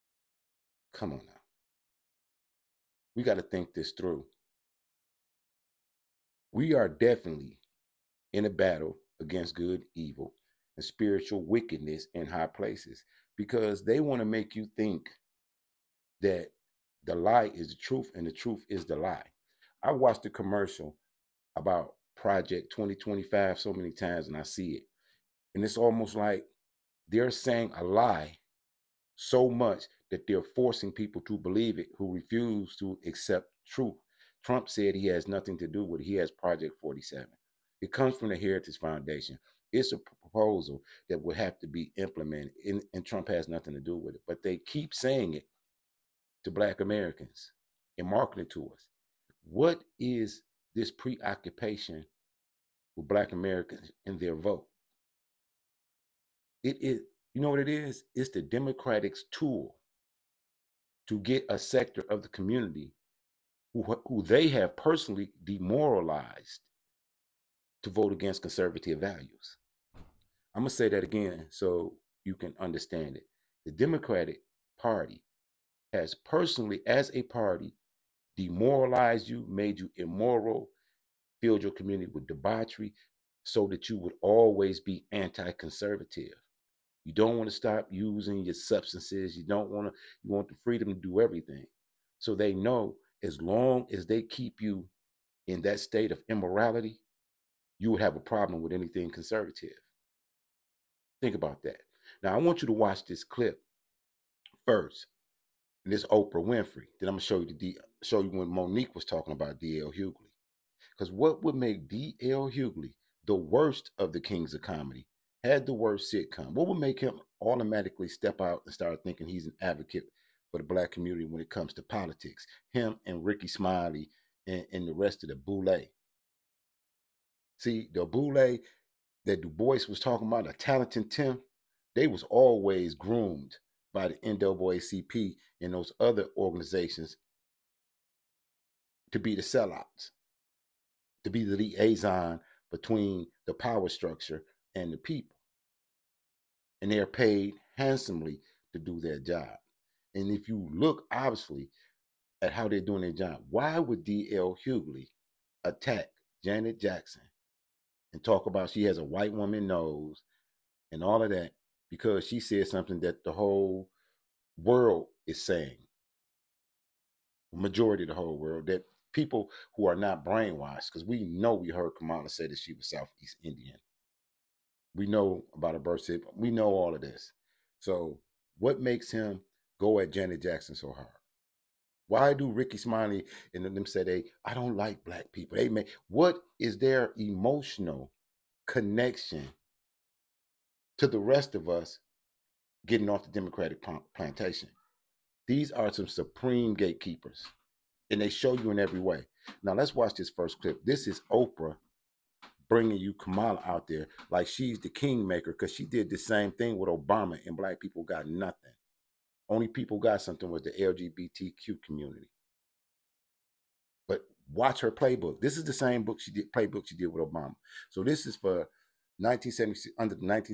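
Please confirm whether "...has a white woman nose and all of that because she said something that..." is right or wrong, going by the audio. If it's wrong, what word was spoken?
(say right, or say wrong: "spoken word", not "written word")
right.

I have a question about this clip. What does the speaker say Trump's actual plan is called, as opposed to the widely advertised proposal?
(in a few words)
Project 47.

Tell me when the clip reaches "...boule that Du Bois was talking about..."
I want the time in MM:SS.
02:08.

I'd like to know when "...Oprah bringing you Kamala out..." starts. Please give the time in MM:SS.
03:21.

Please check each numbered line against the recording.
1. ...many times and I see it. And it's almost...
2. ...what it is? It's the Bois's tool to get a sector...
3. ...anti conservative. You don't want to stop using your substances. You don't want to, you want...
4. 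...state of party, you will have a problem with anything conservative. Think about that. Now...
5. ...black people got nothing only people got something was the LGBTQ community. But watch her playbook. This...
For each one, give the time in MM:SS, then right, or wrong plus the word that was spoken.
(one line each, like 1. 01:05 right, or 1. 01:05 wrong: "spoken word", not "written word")
1. 00:23 right
2. 00:57 wrong: "Democratic", not "Bois"
3. 01:25 right
4. 01:35 wrong: "immorality", not "party"
5. 03:27 right.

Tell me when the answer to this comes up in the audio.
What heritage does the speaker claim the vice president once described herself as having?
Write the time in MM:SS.
02:52.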